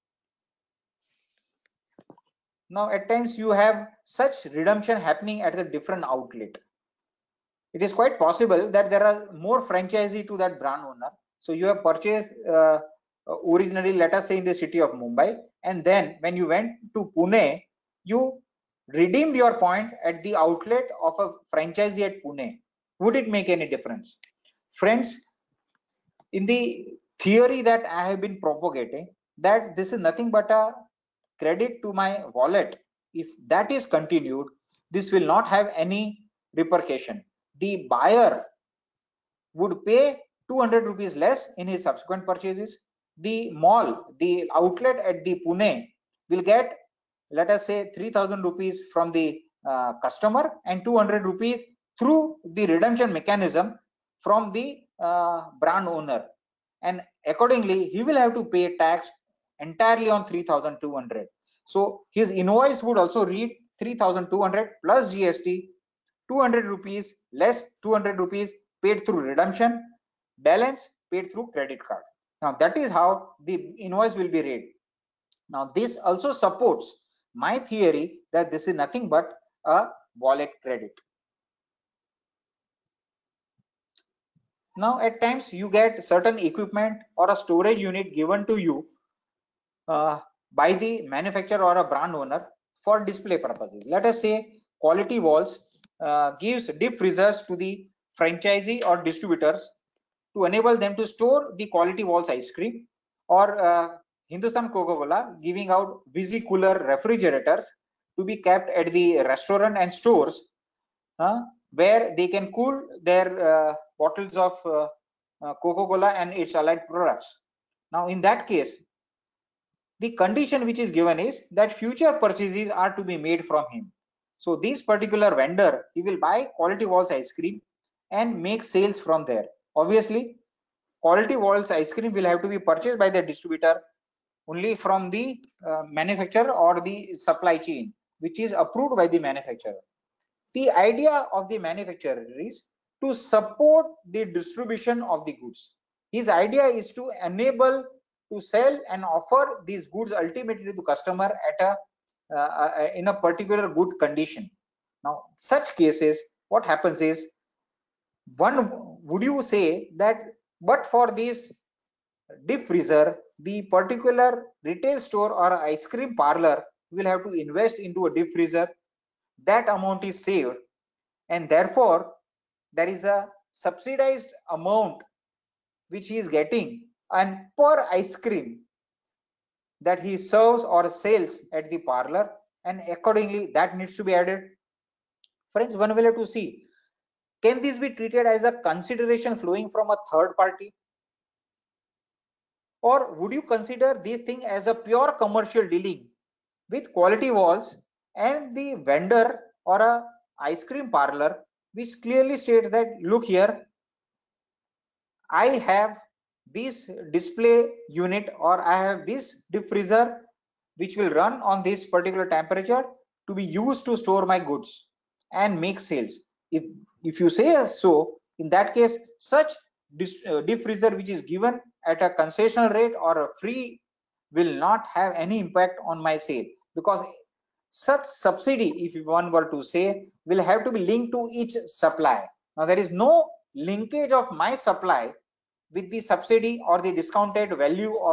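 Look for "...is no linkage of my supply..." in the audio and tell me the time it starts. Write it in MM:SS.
03:52.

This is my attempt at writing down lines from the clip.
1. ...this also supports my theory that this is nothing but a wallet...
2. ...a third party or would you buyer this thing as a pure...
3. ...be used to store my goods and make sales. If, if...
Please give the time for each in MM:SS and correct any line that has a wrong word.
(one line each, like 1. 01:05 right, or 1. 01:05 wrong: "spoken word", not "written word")
1. 01:15 right
2. 03:09 wrong: "consider", not "buyer"
3. 03:33 right.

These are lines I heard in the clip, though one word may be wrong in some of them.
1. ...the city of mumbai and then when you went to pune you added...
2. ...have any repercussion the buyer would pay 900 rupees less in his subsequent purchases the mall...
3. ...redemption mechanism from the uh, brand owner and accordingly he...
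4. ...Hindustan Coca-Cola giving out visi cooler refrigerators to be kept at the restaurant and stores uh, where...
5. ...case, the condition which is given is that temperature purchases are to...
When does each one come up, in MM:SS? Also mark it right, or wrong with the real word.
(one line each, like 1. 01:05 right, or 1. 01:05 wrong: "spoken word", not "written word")
1. 00:14 wrong: "redeemed", not "added"
2. 00:35 wrong: "200", not "900"
3. 00:52 right
4. 01:44 right
5. 01:58 wrong: "future", not "temperature".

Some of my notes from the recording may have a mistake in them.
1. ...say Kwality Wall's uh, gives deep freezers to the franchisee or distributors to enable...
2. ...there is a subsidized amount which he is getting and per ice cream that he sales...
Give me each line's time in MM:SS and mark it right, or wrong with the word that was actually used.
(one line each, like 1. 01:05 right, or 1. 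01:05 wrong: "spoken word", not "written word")
1. 01:34 right
2. 02:52 wrong: "serves", not "sales".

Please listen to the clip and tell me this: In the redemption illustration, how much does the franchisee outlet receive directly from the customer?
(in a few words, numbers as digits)
3000 rupees.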